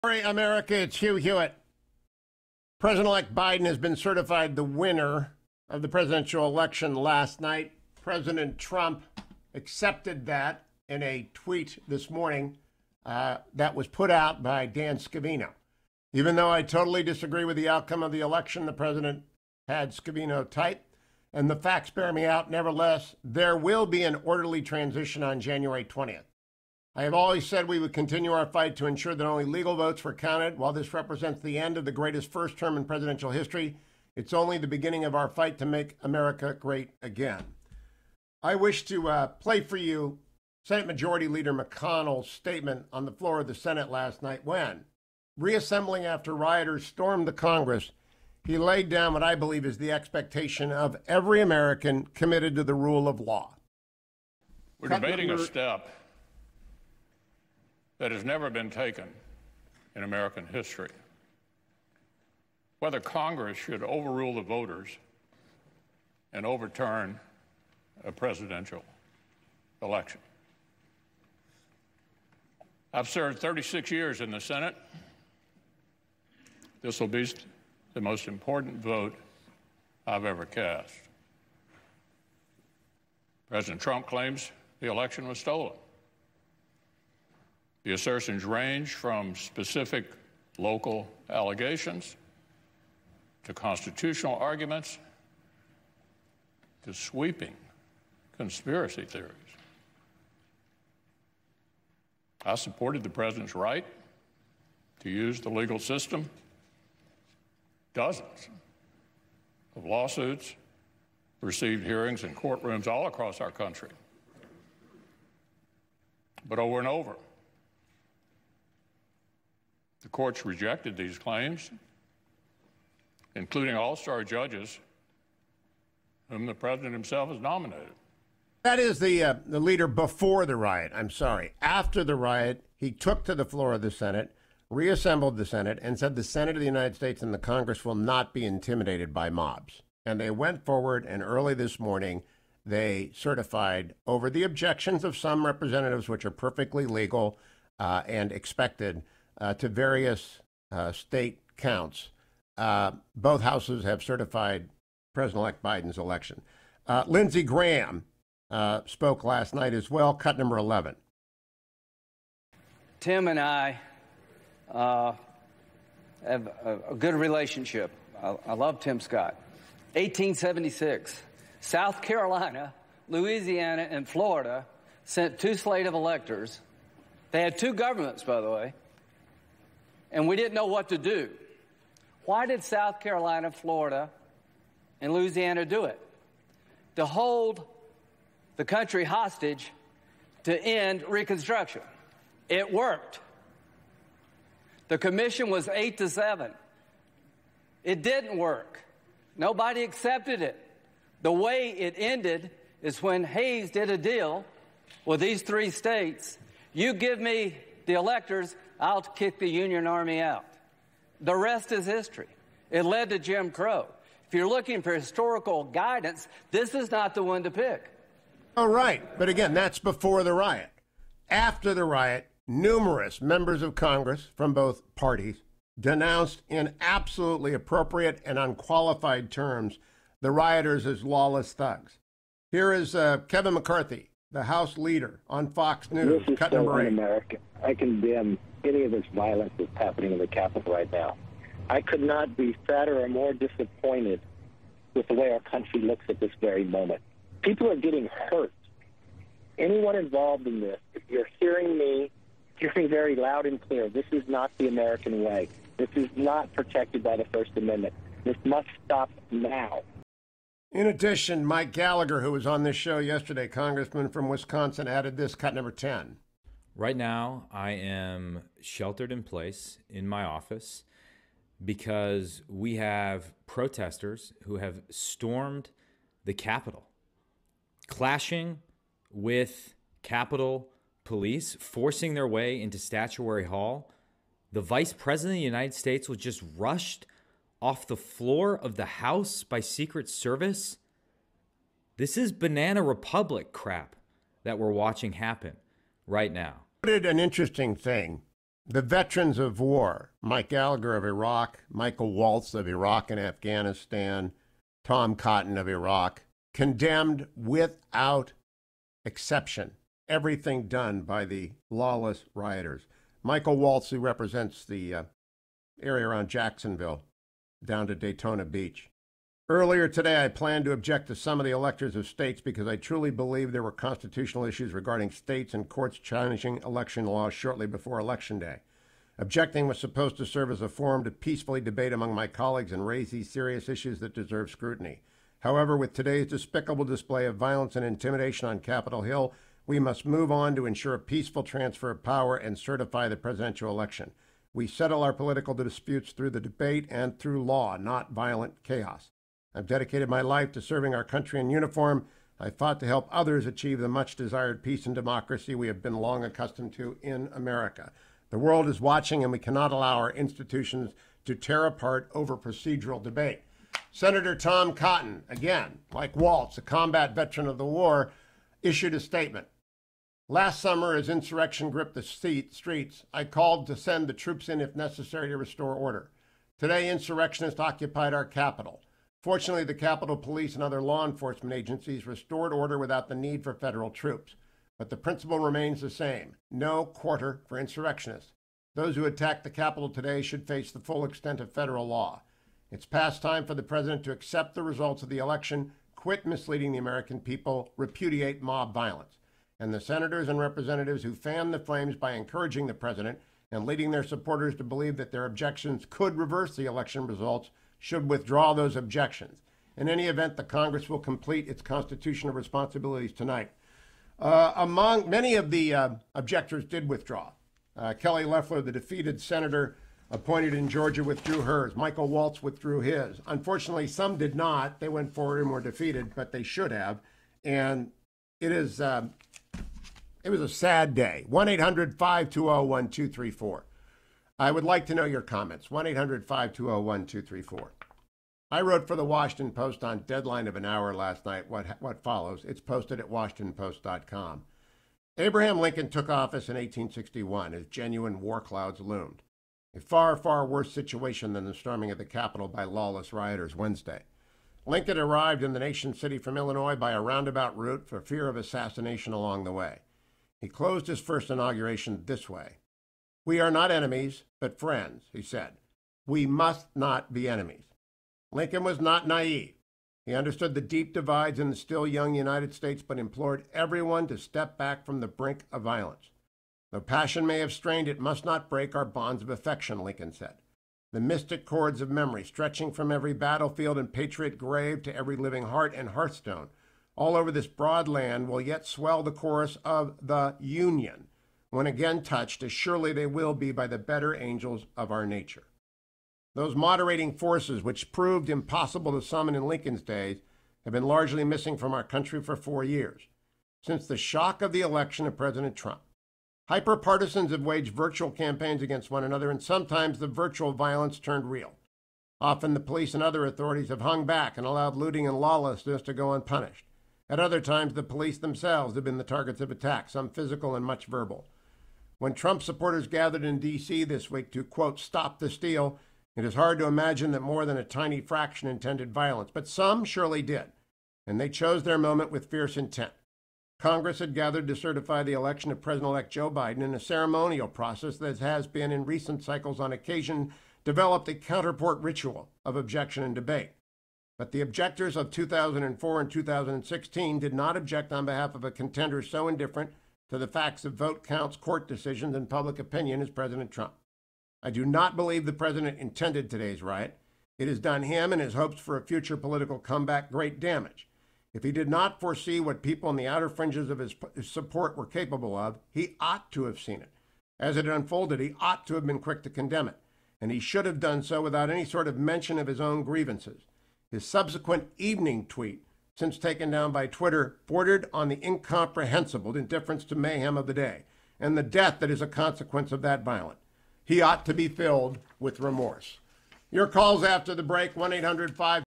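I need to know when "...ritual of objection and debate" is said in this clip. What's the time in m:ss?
9:01.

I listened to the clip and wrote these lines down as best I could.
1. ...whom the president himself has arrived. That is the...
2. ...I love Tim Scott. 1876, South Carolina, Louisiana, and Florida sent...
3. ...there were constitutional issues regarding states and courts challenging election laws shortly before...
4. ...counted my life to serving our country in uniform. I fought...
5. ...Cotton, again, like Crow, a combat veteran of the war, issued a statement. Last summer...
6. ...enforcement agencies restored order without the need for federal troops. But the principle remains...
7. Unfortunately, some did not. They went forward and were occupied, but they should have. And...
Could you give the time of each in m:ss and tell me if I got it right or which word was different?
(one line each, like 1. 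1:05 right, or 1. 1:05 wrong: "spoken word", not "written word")
1. 2:06 wrong: "nominated", not "arrived"
2. 2:48 right
3. 5:23 right
4. 5:49 wrong: "dedicated", not "counted"
5. 6:04 wrong: "Waltz", not "Crow"
6. 6:21 right
7. 7:03 wrong: "defeated", not "occupied".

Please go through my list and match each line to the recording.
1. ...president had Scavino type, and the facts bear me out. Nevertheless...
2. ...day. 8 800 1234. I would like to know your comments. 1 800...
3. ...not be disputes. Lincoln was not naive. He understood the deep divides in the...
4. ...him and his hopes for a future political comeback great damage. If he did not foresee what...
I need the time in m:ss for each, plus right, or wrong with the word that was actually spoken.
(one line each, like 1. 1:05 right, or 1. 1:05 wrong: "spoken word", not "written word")
1. 0:18 right
2. 7:10 wrong: "1", not "8"
3. 7:46 wrong: "enemies", not "disputes"
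4. 9:17 right.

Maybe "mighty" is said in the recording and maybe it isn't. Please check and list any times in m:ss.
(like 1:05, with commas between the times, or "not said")
not said.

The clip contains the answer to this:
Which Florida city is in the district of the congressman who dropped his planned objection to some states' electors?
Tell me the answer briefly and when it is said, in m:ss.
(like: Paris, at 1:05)
Jacksonville, at 5:16.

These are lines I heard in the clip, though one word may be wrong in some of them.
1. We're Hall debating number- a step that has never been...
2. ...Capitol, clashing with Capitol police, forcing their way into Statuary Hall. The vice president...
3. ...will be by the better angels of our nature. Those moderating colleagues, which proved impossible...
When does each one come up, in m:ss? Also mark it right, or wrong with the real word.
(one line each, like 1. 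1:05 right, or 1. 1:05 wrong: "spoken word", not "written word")
1. 0:54 wrong: "Cut", not "Hall"
2. 4:36 right
3. 8:13 wrong: "forces", not "colleagues".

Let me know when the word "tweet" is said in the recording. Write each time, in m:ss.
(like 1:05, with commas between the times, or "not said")
0:11, 9:35.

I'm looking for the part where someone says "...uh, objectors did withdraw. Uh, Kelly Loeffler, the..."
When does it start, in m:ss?
6:55.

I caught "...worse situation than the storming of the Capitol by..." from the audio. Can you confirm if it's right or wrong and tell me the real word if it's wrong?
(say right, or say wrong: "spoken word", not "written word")
right.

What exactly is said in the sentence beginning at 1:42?
I supported the president's right to use the legal system.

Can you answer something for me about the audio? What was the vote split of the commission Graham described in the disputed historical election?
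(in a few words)
8 to 7.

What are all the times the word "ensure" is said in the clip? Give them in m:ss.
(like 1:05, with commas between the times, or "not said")
0:28, 5:40.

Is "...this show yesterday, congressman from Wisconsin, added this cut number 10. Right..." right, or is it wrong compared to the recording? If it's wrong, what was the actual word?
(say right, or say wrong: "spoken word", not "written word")
right.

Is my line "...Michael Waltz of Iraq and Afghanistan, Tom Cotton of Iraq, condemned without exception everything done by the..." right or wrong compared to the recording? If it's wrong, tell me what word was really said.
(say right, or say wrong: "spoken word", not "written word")
right.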